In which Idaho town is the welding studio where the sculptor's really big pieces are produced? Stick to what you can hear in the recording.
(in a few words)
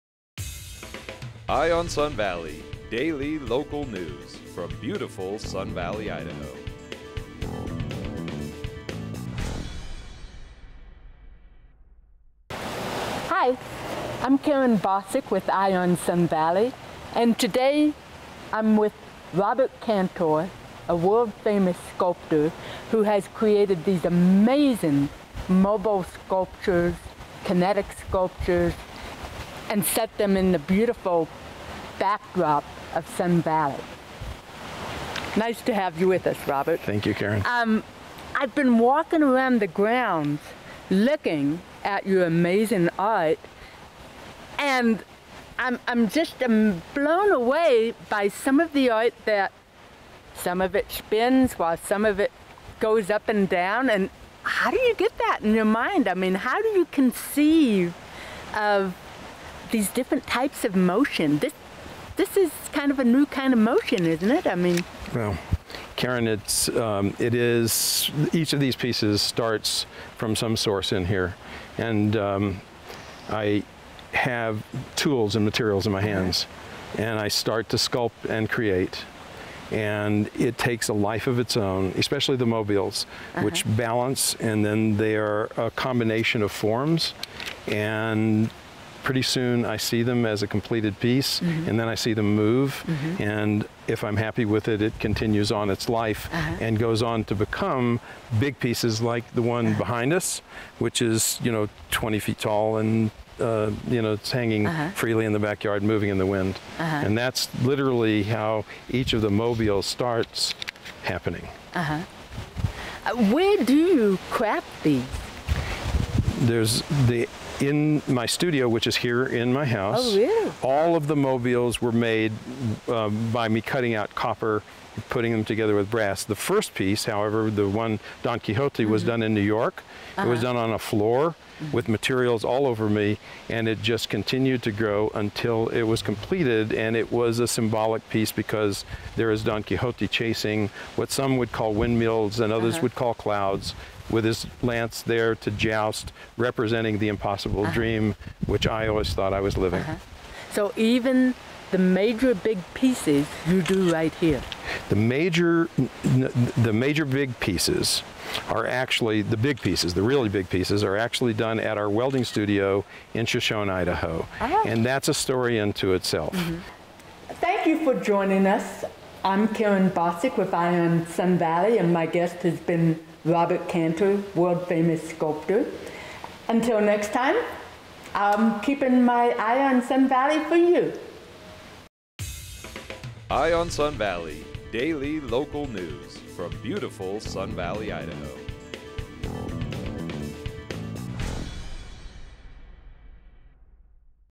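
Shoshone.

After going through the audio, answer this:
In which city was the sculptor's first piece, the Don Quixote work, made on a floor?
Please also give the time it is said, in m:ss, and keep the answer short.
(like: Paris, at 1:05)
New York, at 2:09.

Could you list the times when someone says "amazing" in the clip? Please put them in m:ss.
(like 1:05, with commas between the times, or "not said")
0:24, 0:42.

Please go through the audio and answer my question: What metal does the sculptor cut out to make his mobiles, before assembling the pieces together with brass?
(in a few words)
copper.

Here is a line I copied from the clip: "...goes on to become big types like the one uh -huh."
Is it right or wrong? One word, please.
wrong.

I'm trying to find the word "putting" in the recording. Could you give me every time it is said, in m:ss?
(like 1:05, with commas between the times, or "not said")
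2:05.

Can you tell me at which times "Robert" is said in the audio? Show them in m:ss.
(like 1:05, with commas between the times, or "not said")
0:19, 0:36, 2:53.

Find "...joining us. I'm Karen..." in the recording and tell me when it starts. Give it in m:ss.
2:48.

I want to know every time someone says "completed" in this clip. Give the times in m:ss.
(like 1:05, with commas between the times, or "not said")
1:30, 2:16.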